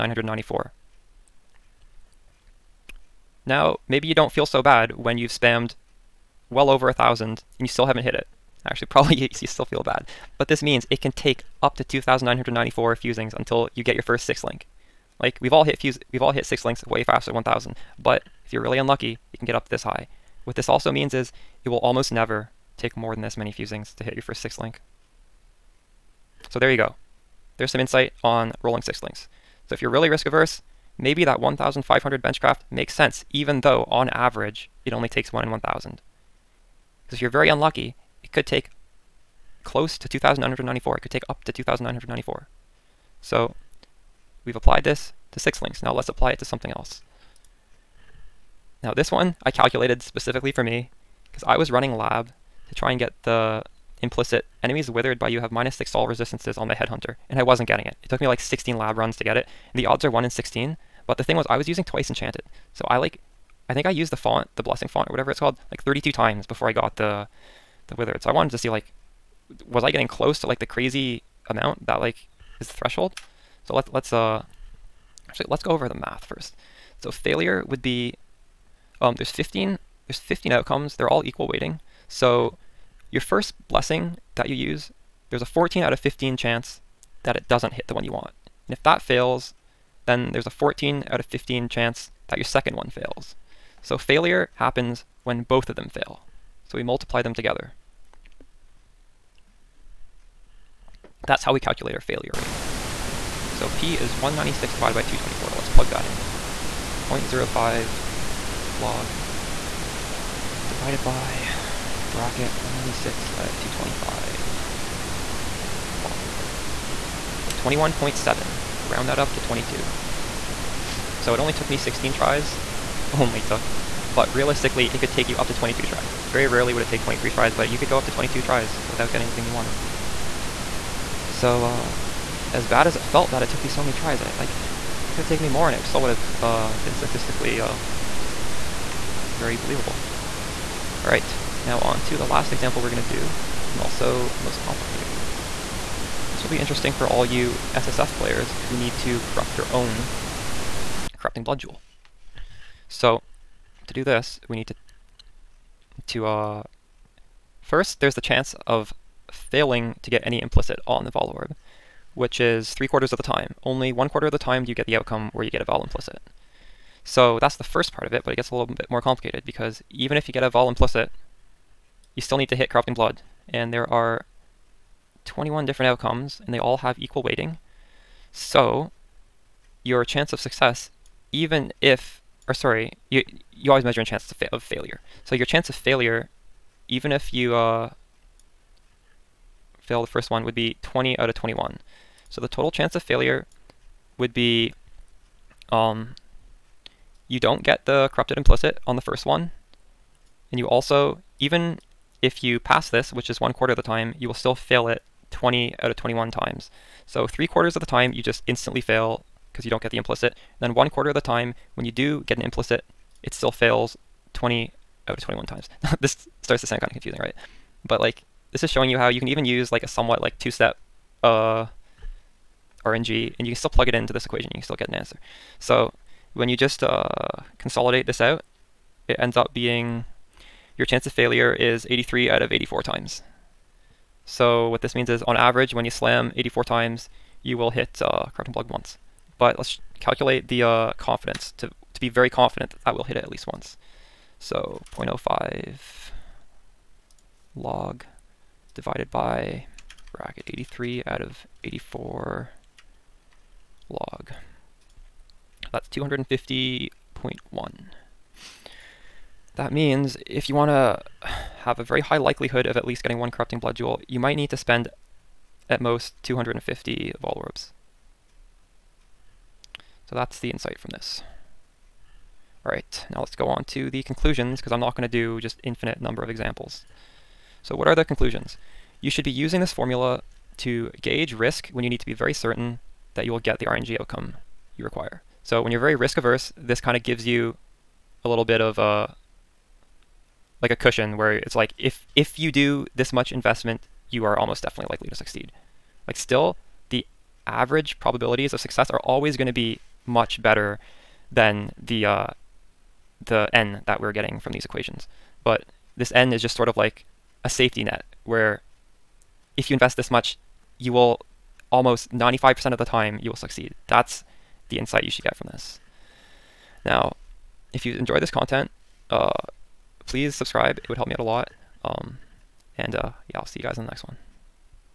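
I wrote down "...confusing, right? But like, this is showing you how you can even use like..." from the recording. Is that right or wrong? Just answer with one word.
right.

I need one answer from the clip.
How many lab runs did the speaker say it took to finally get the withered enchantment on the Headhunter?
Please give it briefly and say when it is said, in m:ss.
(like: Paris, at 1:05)
16, at 0:58.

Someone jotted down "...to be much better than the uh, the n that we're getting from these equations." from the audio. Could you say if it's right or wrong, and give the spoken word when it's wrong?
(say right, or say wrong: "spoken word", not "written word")
right.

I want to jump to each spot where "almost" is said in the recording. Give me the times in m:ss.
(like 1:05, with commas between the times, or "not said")
0:21, 4:54, 5:11.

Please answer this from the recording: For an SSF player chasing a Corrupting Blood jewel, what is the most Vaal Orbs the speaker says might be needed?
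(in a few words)
250.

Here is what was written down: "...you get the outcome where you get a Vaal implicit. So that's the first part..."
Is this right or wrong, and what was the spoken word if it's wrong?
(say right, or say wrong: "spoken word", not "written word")
right.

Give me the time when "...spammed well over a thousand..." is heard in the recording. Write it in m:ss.
0:05.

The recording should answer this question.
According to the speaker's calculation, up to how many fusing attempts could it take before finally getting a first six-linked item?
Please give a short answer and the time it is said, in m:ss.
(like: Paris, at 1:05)
2,994, at 0:11.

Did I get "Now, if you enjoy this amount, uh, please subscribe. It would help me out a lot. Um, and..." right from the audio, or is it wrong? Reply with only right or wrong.
wrong.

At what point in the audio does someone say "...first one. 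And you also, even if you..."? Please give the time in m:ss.
3:18.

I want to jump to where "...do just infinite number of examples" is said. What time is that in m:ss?
4:35.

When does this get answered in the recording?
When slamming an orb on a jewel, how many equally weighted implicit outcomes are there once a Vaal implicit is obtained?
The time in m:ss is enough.
2:55.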